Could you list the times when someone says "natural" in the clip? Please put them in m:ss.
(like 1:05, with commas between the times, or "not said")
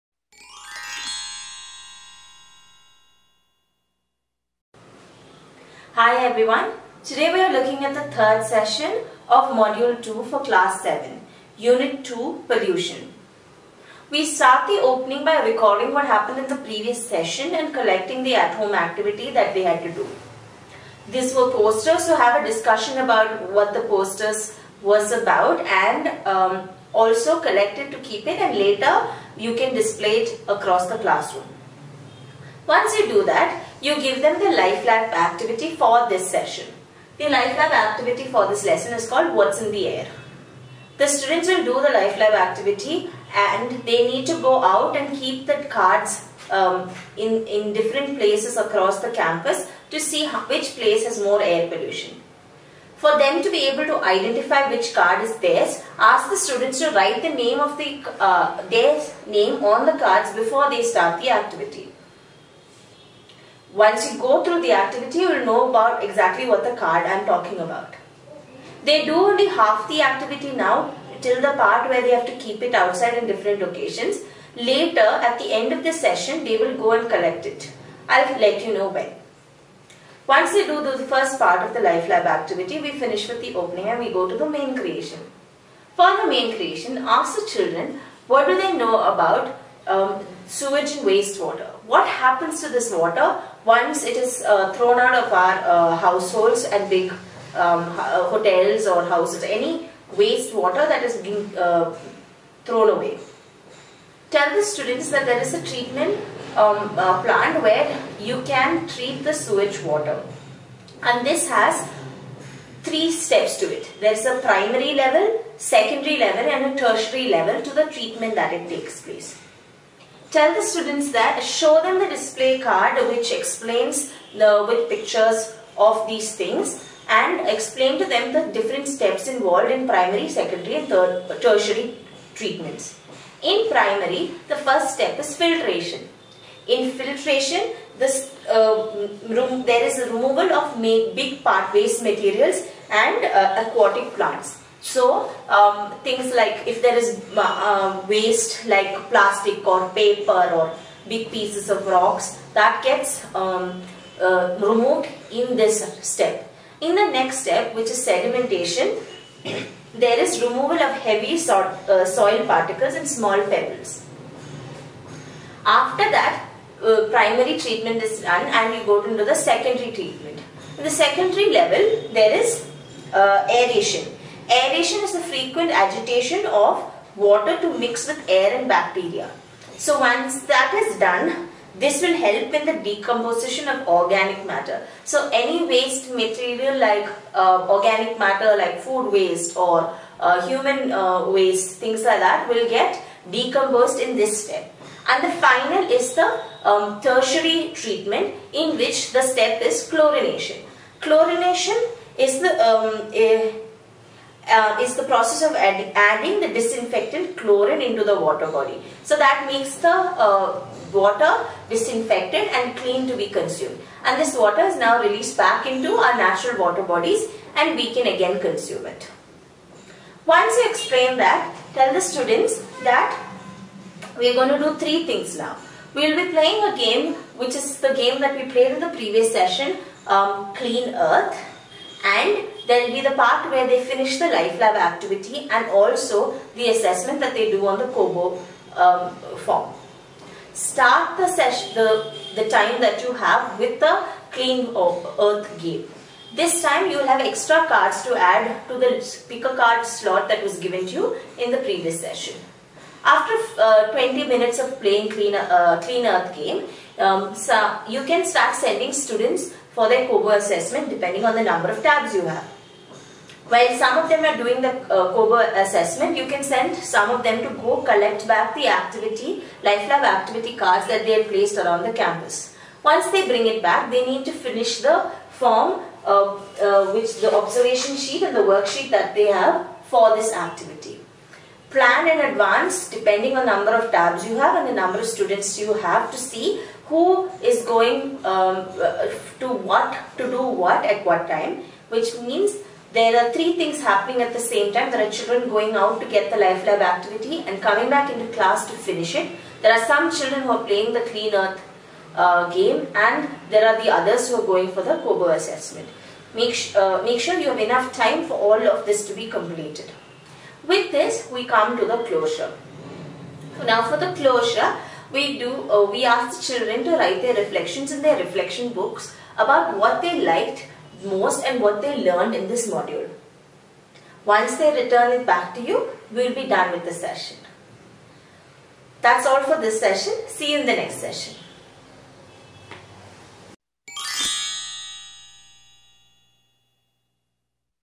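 3:36.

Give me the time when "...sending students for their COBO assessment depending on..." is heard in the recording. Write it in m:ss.
4:18.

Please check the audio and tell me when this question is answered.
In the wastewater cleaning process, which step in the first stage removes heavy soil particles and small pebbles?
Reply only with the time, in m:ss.
2:38.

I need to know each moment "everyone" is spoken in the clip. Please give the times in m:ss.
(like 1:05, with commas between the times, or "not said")
0:06.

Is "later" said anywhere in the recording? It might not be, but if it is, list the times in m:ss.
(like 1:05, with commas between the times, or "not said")
0:28, 1:14.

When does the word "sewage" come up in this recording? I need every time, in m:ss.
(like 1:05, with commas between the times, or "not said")
1:30, 1:49.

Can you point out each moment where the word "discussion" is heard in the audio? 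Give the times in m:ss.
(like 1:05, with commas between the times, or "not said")
0:22.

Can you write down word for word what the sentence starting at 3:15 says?
And the final is the um, tertiary treatment in which the step is chlorination.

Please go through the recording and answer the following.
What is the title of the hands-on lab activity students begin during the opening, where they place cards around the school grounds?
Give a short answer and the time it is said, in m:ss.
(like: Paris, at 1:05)
What's in the Air, at 0:39.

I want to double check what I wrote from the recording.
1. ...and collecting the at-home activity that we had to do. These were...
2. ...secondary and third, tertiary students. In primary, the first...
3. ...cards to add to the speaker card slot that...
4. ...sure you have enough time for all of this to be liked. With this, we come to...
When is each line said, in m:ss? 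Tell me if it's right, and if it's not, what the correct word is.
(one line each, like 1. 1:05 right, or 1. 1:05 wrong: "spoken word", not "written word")
1. 0:17 right
2. 2:10 wrong: "treatments", not "students"
3. 4:07 right
4. 5:07 wrong: "completed", not "liked".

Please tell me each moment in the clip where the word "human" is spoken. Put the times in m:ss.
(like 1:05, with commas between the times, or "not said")
3:10.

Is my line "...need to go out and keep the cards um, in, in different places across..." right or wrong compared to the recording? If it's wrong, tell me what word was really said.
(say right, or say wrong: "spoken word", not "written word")
right.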